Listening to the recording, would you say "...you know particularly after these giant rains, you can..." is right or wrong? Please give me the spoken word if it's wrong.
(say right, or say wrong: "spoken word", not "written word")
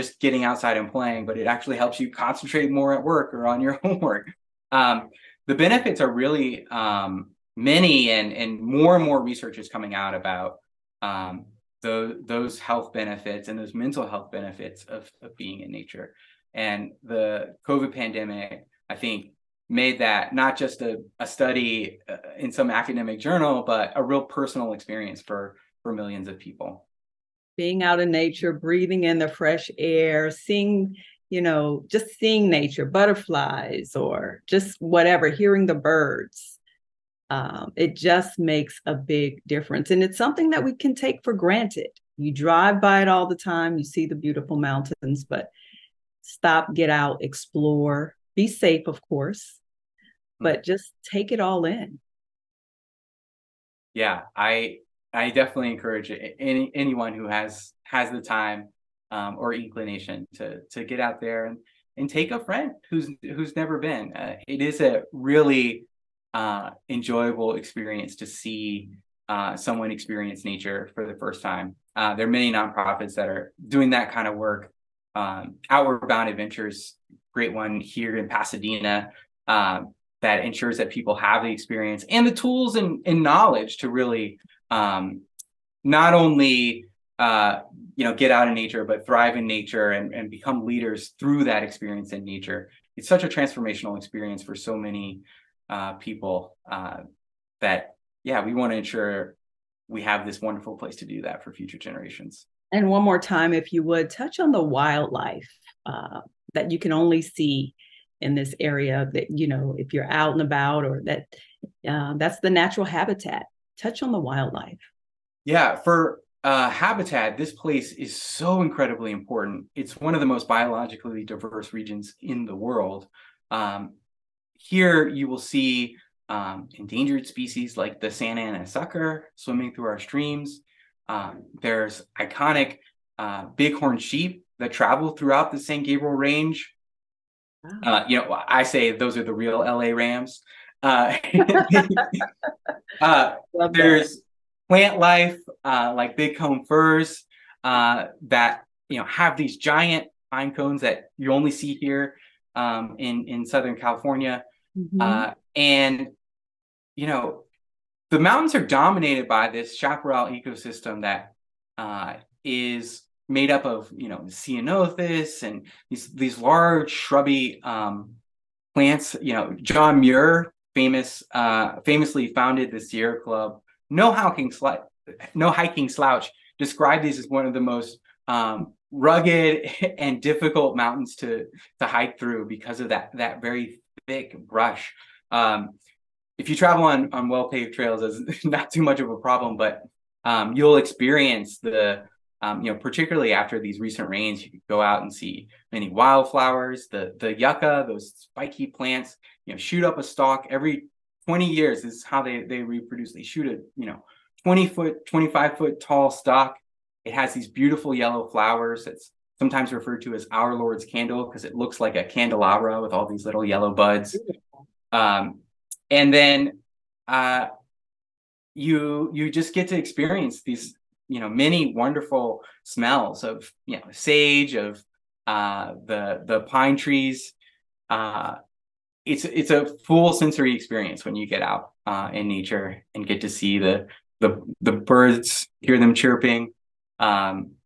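wrong: "recent", not "giant".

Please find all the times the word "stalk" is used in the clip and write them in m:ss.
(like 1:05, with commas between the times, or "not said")
3:20, 3:26.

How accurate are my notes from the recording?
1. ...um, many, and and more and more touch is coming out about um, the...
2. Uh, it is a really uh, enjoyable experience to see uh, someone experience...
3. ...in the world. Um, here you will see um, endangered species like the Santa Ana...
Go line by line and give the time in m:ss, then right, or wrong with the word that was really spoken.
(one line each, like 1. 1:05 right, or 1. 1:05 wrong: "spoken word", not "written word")
1. 0:06 wrong: "research", not "touch"
2. 1:04 right
3. 2:02 right.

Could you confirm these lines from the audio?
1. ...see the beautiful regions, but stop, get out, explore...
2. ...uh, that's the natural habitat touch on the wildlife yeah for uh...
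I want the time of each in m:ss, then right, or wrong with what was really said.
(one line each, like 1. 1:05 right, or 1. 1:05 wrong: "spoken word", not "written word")
1. 0:43 wrong: "mountains", not "regions"
2. 1:51 right.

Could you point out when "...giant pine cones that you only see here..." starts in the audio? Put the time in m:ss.
2:29.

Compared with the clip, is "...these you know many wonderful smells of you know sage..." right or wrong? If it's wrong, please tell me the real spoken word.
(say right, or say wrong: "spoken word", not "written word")
right.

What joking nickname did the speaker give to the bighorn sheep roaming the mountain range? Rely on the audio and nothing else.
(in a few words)
the real LA Rams.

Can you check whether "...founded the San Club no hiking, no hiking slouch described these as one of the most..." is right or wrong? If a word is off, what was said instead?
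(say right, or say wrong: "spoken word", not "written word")
wrong: "Sierra", not "San".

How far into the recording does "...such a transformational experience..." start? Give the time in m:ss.
1:33.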